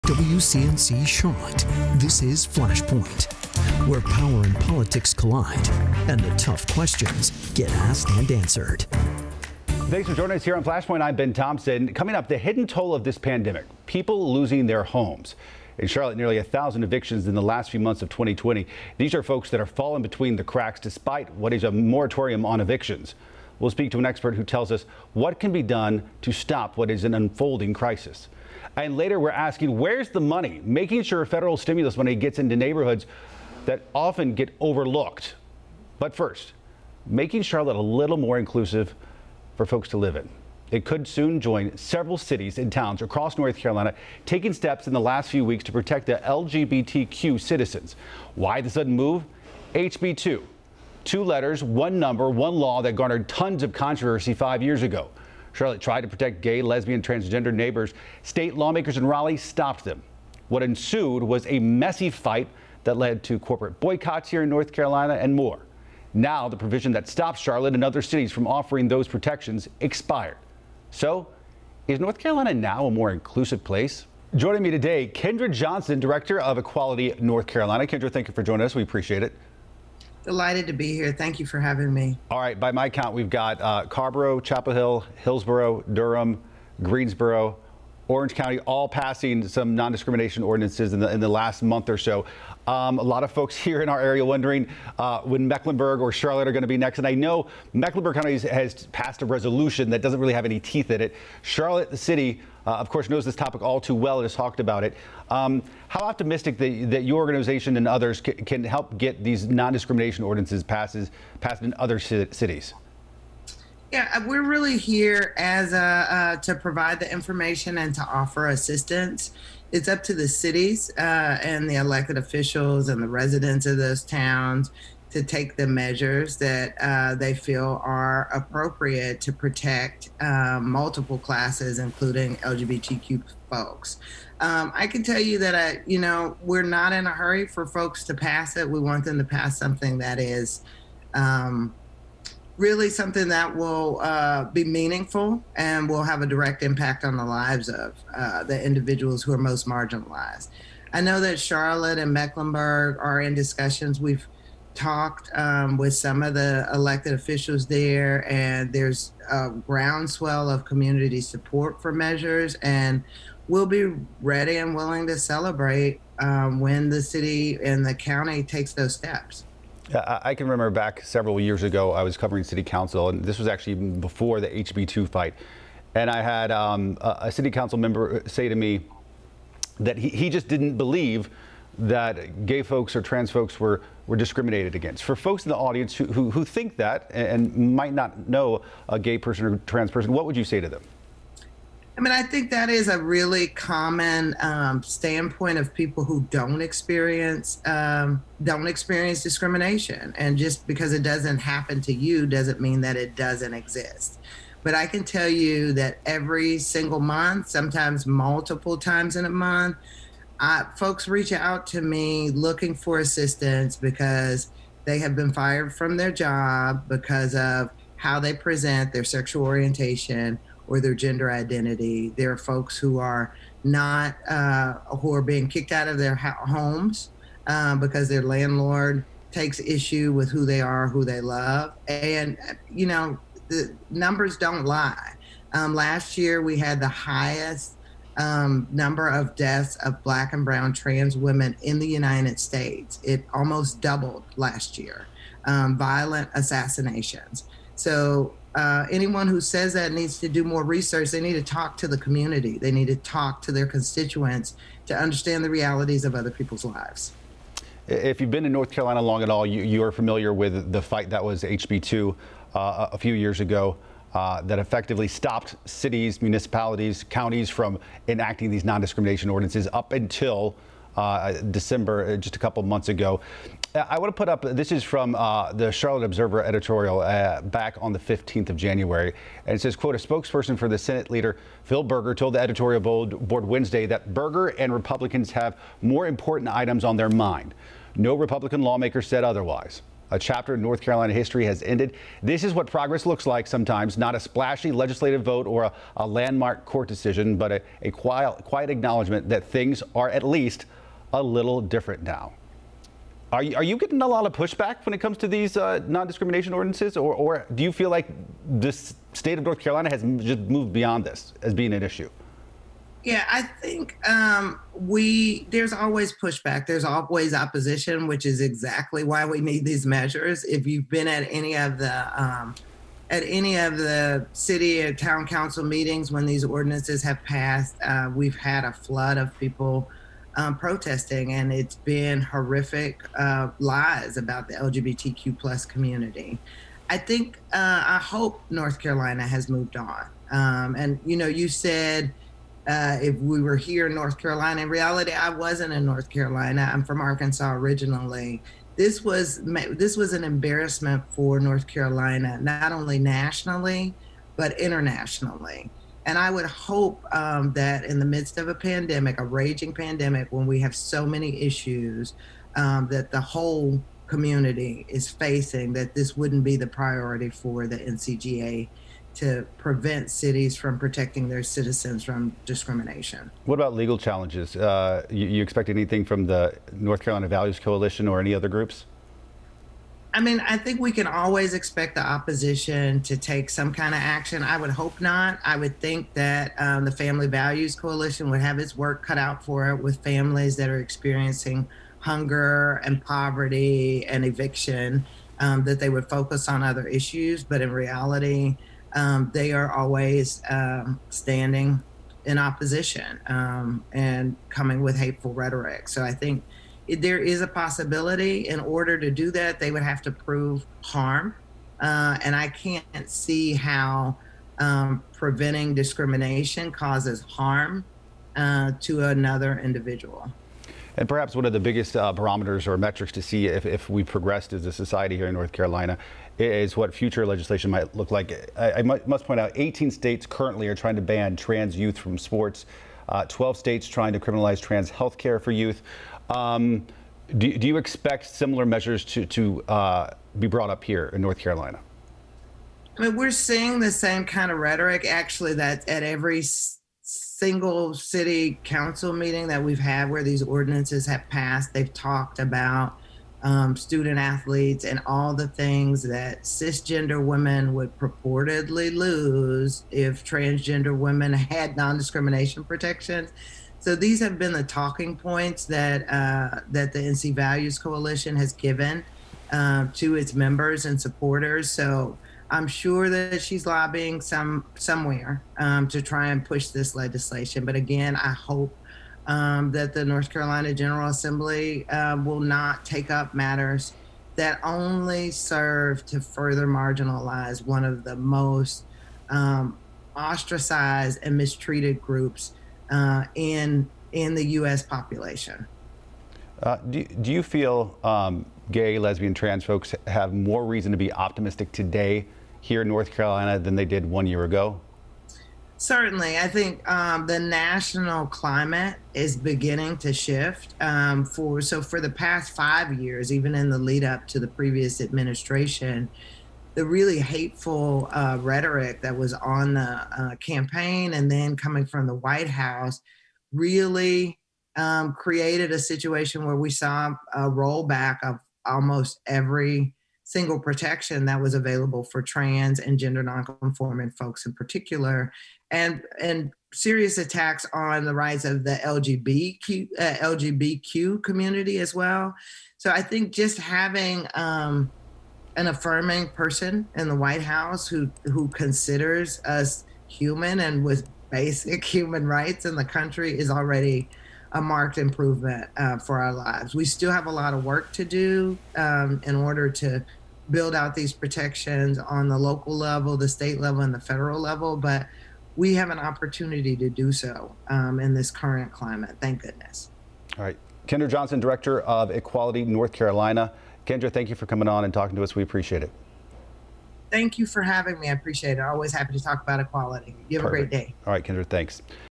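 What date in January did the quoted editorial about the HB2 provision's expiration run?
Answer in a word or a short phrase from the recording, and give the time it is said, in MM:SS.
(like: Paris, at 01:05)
January 15, at 04:37.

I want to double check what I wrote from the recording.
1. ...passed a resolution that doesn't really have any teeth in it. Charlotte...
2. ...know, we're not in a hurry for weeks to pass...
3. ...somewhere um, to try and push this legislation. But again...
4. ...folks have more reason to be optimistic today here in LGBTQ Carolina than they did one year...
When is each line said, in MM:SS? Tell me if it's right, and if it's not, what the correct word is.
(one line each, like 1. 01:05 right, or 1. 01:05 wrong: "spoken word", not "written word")
1. 01:38 right
2. 02:15 wrong: "folks", not "weeks"
3. 07:54 right
4. 08:19 wrong: "North", not "LGBTQ".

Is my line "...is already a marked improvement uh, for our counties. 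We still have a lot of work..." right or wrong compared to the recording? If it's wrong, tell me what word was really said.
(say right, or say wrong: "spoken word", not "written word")
wrong: "lives", not "counties".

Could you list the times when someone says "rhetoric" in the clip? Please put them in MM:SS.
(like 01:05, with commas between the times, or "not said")
06:45, 07:24, 08:38.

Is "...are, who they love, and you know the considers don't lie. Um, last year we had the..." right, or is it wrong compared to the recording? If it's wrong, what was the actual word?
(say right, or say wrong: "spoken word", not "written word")
wrong: "numbers", not "considers".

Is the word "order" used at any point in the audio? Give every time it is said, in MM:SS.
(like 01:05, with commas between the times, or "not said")
06:48, 09:19.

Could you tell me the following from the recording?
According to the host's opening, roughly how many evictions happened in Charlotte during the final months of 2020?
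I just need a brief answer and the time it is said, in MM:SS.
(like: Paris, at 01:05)
nearly a thousand, at 00:16.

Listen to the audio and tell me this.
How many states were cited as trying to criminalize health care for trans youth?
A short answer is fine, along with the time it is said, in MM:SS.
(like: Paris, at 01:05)
12, at 07:13.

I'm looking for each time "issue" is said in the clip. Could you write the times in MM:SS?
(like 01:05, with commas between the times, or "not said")
03:49, 05:11, 06:01, 06:36.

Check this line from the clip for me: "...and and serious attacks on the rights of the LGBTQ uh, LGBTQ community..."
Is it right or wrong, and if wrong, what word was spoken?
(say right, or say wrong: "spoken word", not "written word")
right.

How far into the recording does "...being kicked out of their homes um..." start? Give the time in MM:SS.
03:45.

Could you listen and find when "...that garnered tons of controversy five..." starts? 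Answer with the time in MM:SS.
00:52.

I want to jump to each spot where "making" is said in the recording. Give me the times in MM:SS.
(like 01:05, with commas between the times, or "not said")
00:30, 00:37.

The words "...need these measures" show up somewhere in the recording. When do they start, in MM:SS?
05:19.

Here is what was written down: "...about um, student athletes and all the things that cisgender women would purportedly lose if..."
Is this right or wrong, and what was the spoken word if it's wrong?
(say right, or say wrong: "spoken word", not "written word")
right.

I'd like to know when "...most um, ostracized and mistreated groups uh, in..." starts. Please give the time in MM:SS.
08:08.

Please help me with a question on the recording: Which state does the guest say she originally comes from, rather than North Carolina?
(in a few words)
Arkansas.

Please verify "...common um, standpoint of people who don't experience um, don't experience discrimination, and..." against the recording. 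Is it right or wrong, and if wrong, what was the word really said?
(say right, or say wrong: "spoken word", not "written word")
right.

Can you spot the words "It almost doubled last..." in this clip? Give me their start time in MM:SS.
04:03.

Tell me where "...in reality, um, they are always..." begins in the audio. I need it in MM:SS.
06:37.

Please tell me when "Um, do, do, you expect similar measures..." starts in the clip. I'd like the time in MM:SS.
07:16.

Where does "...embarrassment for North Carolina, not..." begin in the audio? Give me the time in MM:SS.
05:50.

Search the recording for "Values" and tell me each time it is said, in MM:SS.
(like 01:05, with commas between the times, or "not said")
06:17, 06:27, 07:47.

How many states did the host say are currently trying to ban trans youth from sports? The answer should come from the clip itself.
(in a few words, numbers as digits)
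18.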